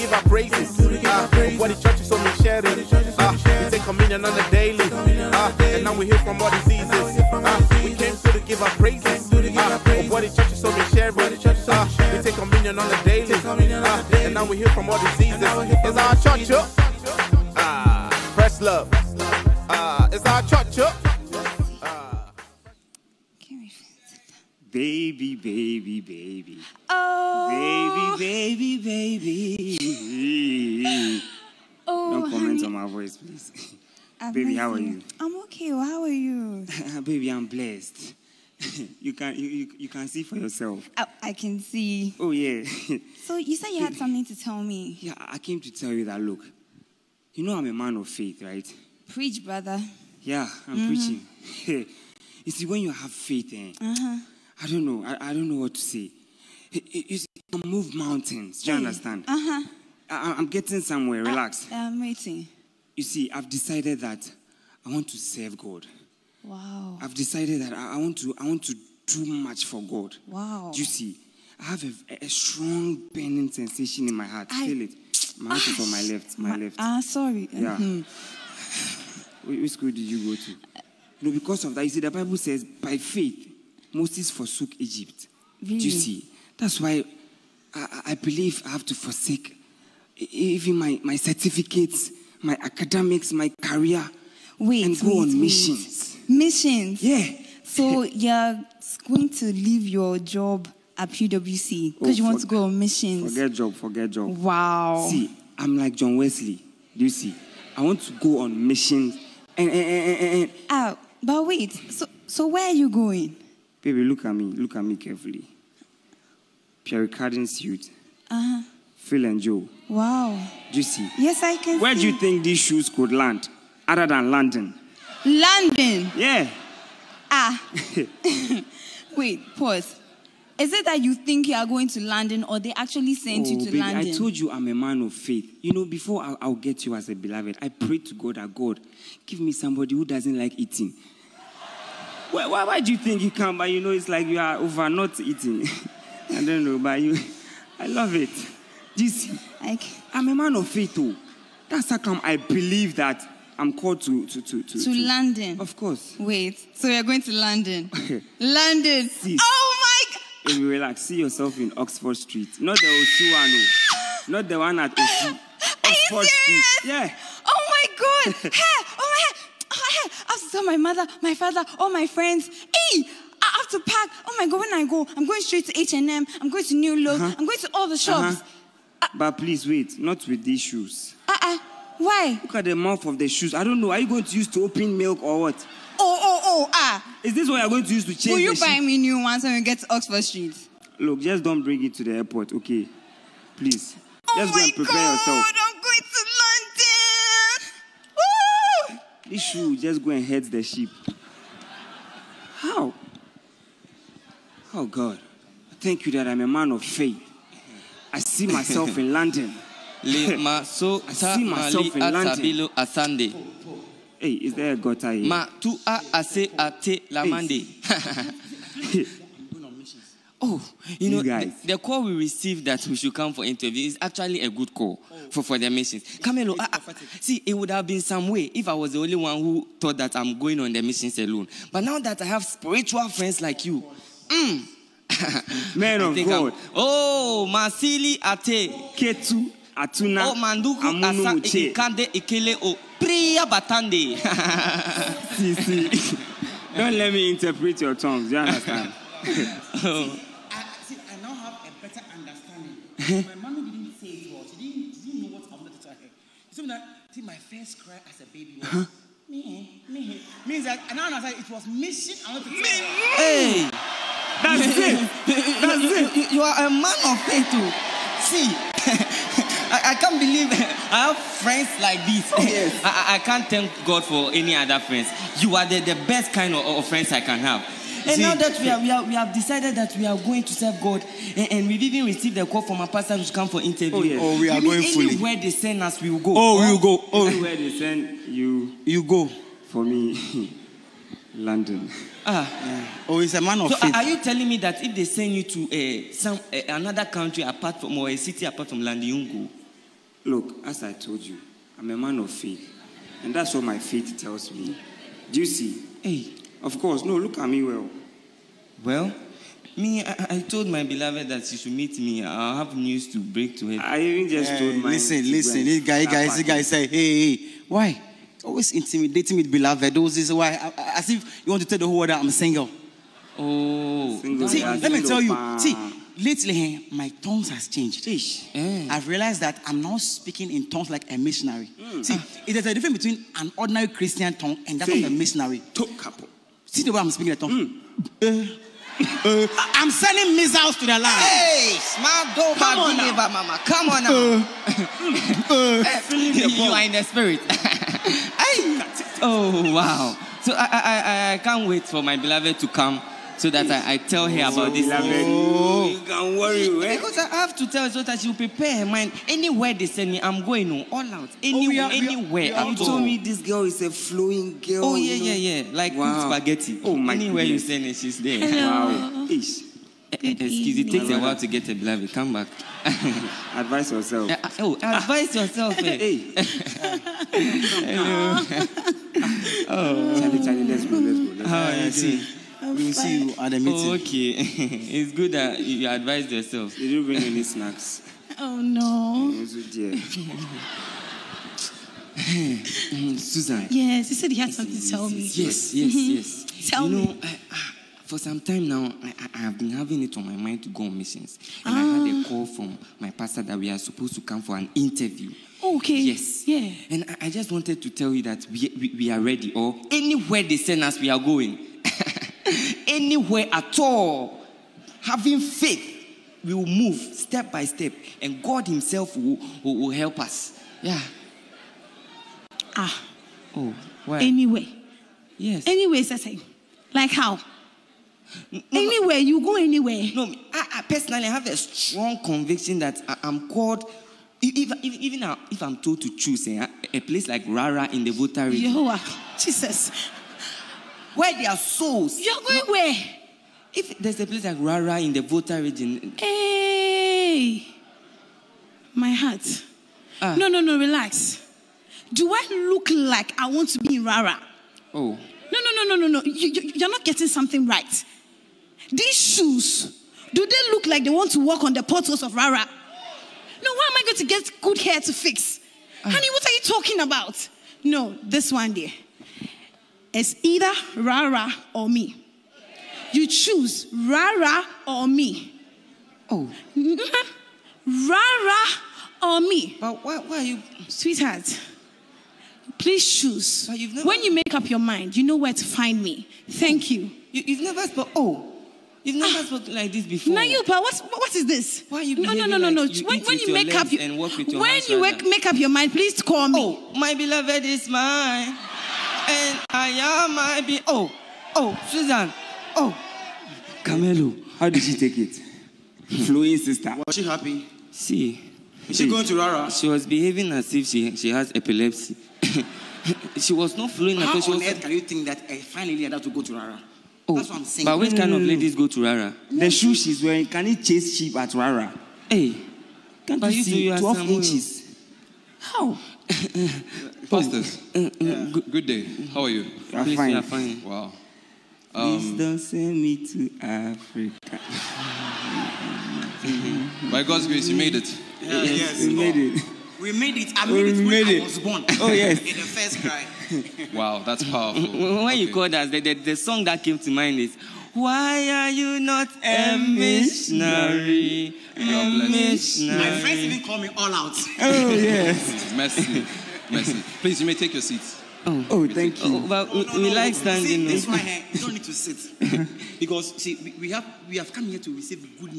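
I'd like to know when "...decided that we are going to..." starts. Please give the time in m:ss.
4:39.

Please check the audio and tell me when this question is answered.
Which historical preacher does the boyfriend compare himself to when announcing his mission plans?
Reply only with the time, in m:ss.
1:45.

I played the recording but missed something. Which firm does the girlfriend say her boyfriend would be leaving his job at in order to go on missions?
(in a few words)
PwC.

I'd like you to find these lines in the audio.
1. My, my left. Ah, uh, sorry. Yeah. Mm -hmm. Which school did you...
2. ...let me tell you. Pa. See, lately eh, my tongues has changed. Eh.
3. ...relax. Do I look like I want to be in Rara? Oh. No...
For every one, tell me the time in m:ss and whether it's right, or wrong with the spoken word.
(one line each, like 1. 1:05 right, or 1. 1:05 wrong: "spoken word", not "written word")
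1. 1:16 right
2. 5:24 right
3. 7:30 right.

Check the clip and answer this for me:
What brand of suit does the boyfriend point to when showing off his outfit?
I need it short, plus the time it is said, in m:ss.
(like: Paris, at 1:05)
Pierre Cardin, at 1:56.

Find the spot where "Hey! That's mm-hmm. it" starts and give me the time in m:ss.
4:23.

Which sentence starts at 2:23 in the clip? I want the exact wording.
But you know, it's like you are over not eating.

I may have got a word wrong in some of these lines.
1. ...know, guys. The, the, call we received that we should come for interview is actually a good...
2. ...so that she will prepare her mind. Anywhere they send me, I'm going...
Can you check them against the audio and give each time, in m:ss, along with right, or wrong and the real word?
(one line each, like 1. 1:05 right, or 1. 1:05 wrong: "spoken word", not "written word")
1. 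3:41 right
2. 5:57 right.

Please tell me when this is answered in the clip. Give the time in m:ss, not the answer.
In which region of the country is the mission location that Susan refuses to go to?
7:25.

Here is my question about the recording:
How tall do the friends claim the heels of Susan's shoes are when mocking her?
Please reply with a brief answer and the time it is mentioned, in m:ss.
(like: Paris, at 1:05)
12 inches, at 8:43.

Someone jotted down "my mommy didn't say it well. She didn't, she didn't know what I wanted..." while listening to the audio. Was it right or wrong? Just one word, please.
right.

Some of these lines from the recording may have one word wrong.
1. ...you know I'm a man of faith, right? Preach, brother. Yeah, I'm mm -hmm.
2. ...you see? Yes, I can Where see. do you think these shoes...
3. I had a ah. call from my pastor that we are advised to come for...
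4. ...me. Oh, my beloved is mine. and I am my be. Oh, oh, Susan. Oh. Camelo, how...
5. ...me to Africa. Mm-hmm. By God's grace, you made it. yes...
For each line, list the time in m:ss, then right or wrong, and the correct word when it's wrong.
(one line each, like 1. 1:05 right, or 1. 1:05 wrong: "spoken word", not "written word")
1. 0:47 right
2. 2:00 right
3. 6:41 wrong: "supposed", not "advised"
4. 8:16 right
5. 8:53 right.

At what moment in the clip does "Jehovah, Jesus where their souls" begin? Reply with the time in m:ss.
7:18.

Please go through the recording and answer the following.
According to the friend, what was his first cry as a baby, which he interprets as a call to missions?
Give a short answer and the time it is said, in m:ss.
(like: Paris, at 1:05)
me, me, at 4:19.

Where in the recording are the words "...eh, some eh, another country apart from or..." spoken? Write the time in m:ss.
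4:56.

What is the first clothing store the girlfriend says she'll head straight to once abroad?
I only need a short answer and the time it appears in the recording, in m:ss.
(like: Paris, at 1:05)
H&M, at 2:55.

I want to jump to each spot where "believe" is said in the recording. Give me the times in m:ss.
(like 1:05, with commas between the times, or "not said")
1:28, 2:32, 4:30.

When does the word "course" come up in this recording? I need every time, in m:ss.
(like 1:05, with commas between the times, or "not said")
2:35, 5:06.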